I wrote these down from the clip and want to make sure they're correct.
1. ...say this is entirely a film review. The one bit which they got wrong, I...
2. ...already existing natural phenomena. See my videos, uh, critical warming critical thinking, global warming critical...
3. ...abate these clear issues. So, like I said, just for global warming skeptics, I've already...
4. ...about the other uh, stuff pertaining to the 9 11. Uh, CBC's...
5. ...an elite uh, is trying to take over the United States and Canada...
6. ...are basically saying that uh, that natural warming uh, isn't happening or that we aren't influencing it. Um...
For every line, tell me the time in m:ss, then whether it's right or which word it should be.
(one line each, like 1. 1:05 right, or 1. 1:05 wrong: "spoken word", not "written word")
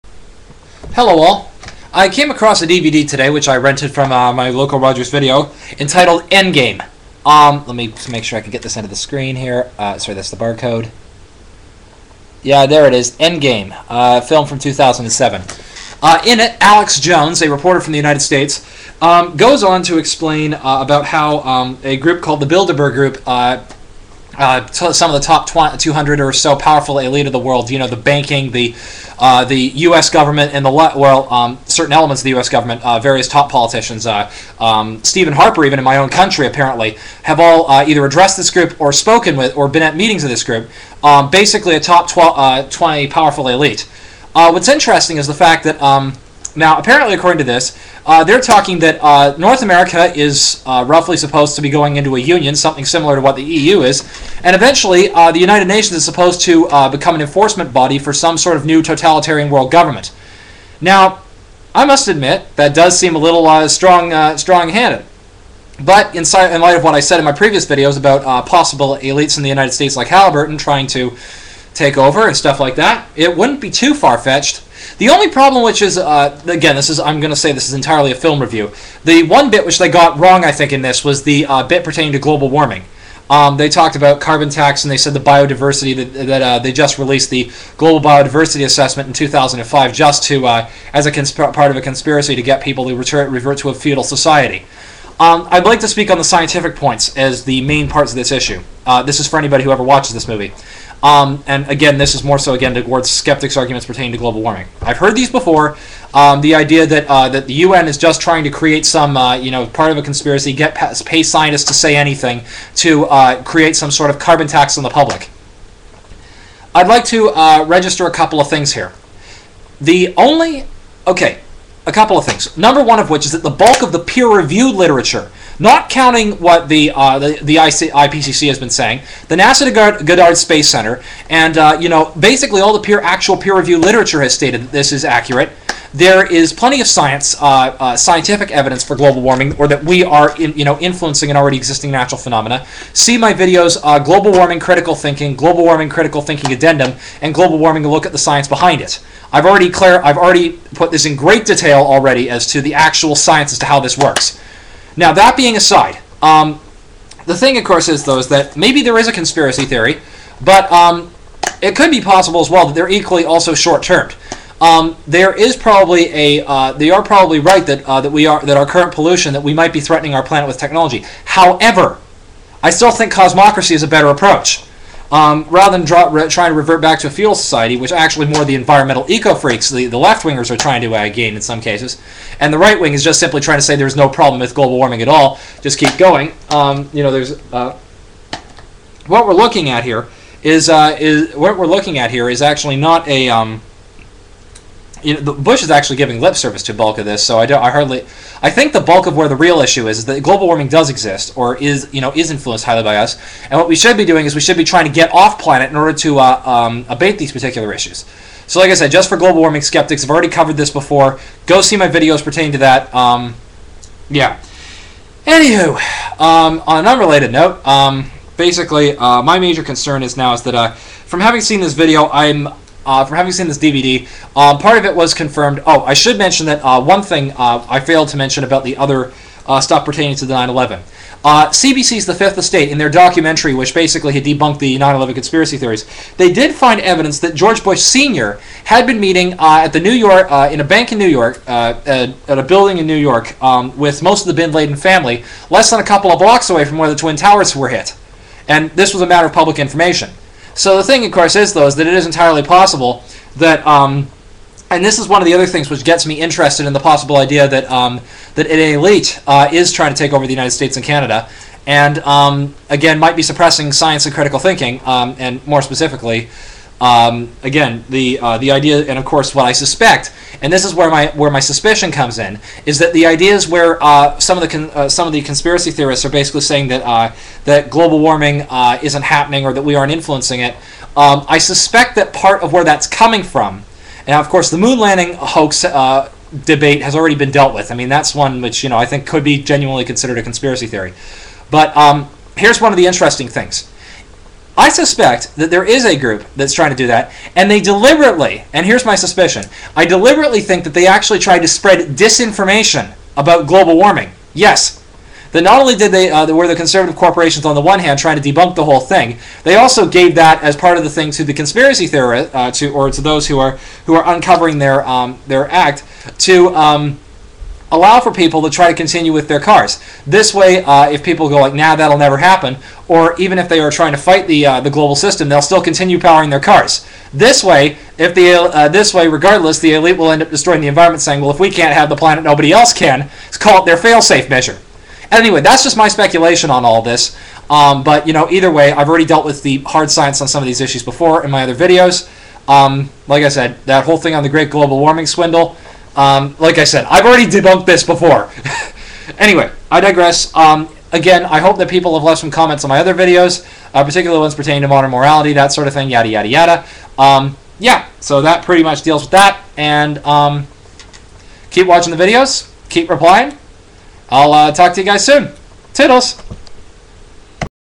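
1. 1:17 right
2. 2:21 wrong: "global", not "critical"
3. 3:26 wrong: "particular", not "clear"
4. 3:48 right
5. 4:18 right
6. 4:36 wrong: "global", not "natural".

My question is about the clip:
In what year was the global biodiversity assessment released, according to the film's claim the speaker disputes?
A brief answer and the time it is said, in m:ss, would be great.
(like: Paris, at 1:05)
2005, at 1:29.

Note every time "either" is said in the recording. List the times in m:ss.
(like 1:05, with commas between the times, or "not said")
0:37, 5:38.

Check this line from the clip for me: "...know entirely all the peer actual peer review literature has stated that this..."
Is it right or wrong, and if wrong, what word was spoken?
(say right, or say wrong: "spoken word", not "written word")
wrong: "basically", not "entirely".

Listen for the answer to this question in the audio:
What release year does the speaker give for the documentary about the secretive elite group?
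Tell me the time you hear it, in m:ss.
0:14.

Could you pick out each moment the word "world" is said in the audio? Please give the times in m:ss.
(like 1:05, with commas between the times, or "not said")
0:27, 0:59.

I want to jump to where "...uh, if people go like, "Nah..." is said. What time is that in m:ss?
5:20.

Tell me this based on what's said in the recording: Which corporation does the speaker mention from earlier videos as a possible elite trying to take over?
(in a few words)
Halliburton.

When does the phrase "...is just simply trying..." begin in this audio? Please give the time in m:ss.
3:02.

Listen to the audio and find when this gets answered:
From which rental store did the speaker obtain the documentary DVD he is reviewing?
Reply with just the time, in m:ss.
0:04.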